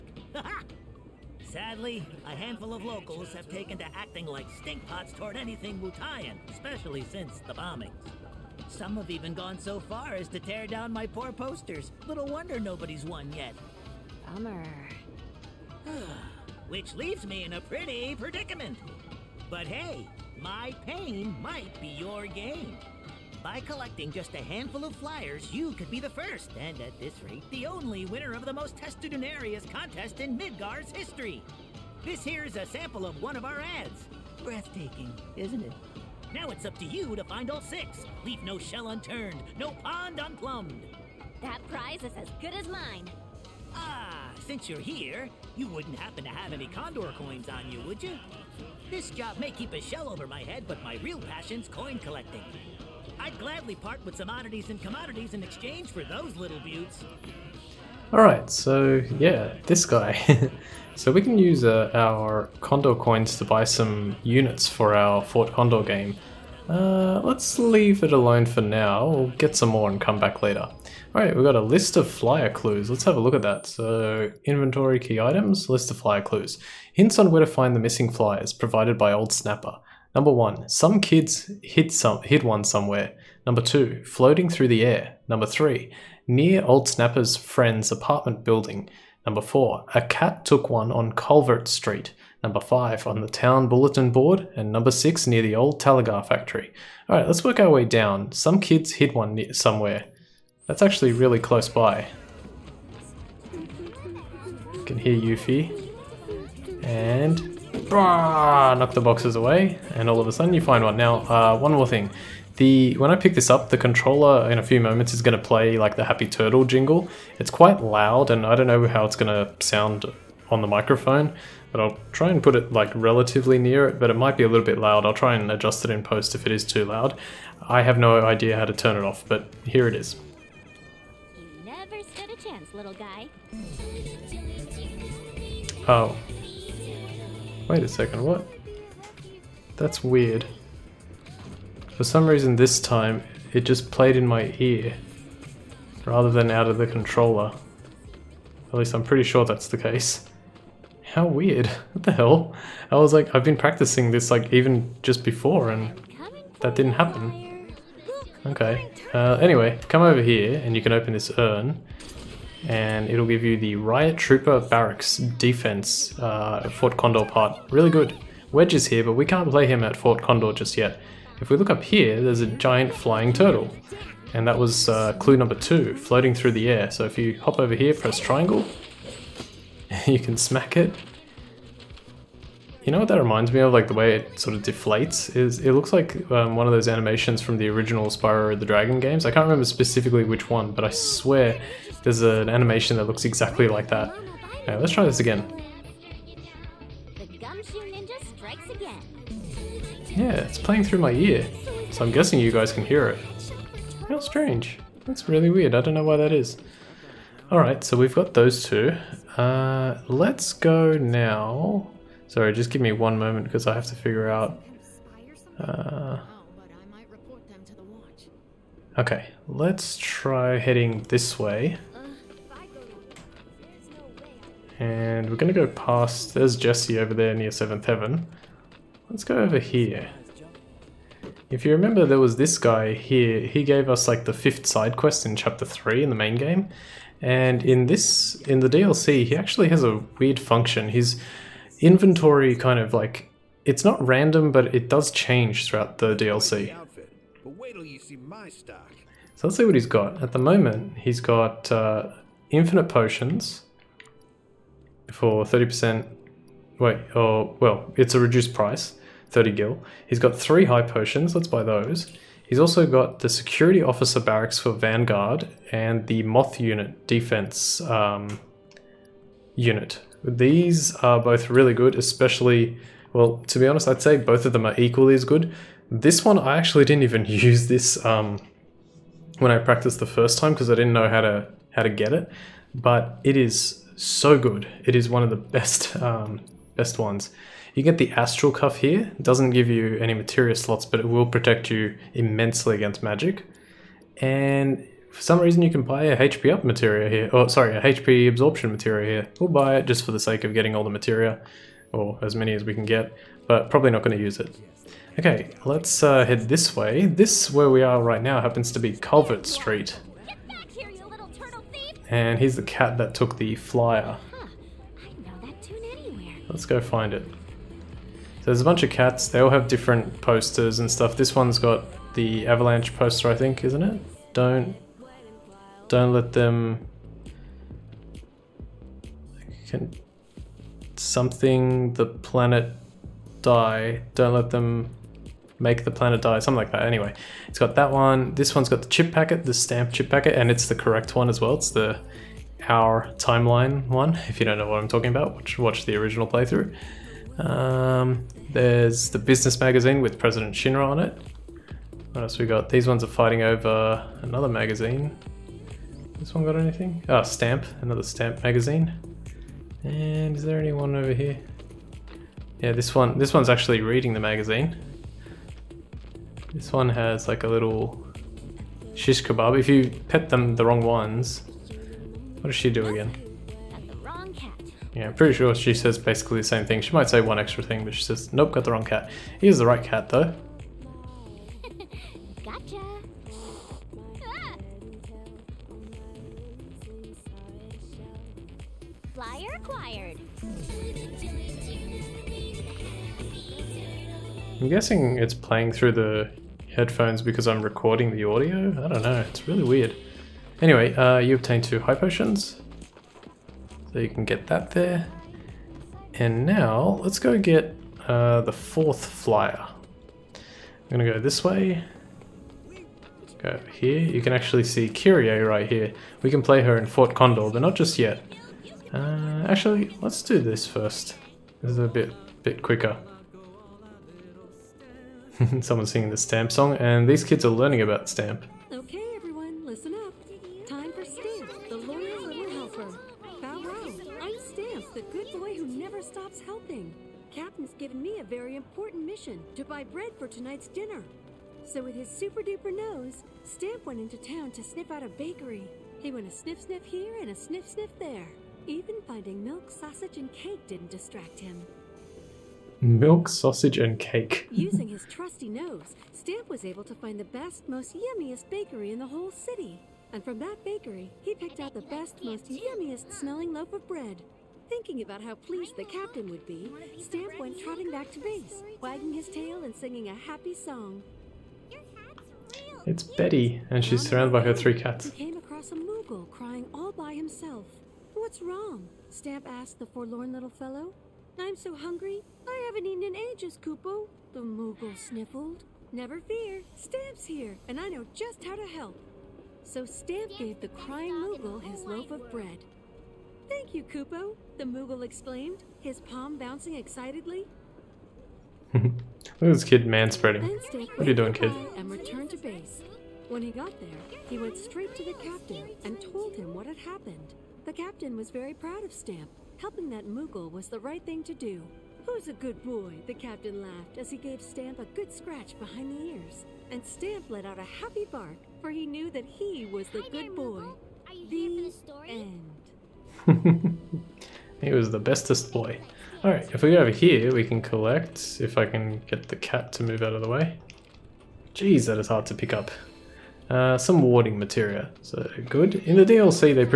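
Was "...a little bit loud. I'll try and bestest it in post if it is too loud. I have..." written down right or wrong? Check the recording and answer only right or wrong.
wrong.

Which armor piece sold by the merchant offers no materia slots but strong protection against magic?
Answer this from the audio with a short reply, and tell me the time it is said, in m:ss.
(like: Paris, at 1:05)
Astral Cuff, at 4:48.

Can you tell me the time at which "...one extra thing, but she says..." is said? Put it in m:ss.
6:17.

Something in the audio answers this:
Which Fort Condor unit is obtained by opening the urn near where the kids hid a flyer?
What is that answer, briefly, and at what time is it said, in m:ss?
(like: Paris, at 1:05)
Riot Trooper Barracks, at 2:43.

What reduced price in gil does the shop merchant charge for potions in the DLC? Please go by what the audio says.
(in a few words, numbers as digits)
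30 gil.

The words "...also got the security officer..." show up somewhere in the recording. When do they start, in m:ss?
4:22.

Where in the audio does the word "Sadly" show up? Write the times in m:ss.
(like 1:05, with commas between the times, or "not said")
0:01.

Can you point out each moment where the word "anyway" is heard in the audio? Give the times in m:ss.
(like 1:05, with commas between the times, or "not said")
2:39, 5:36, 6:40.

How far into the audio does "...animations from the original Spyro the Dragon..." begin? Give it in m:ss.
3:06.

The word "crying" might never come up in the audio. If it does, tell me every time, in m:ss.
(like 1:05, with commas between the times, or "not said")
7:56, 8:10.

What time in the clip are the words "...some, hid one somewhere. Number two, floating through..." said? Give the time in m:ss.
1:21.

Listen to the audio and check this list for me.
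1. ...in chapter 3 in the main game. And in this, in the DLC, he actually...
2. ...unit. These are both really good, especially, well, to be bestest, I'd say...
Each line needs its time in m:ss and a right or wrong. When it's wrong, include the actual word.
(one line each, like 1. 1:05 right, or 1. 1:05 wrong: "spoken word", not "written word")
1. 3:55 right
2. 4:29 wrong: "honest", not "bestest".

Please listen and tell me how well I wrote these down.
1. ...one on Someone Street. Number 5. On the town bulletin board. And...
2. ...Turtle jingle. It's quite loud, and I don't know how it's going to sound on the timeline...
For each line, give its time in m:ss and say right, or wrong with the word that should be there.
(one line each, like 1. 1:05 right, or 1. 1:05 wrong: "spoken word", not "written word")
1. 1:30 wrong: "Culvert", not "Someone"
2. 1:56 wrong: "microphone", not "timeline".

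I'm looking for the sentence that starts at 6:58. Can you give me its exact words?
Uh, actually, let's do this first.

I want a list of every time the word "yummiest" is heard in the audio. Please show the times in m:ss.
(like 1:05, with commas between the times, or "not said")
7:37, 7:42.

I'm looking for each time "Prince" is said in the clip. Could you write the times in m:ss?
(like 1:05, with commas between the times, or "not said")
not said.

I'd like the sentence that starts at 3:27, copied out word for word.
Alright, so we've got those two.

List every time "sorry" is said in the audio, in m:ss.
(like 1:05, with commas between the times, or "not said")
3:32, 4:57.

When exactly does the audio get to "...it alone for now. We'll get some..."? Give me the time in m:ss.
1:08.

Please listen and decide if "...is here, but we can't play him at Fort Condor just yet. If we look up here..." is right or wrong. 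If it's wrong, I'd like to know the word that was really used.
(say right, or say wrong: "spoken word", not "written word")
right.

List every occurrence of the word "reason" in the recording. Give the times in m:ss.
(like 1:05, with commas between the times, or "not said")
2:22, 4:55.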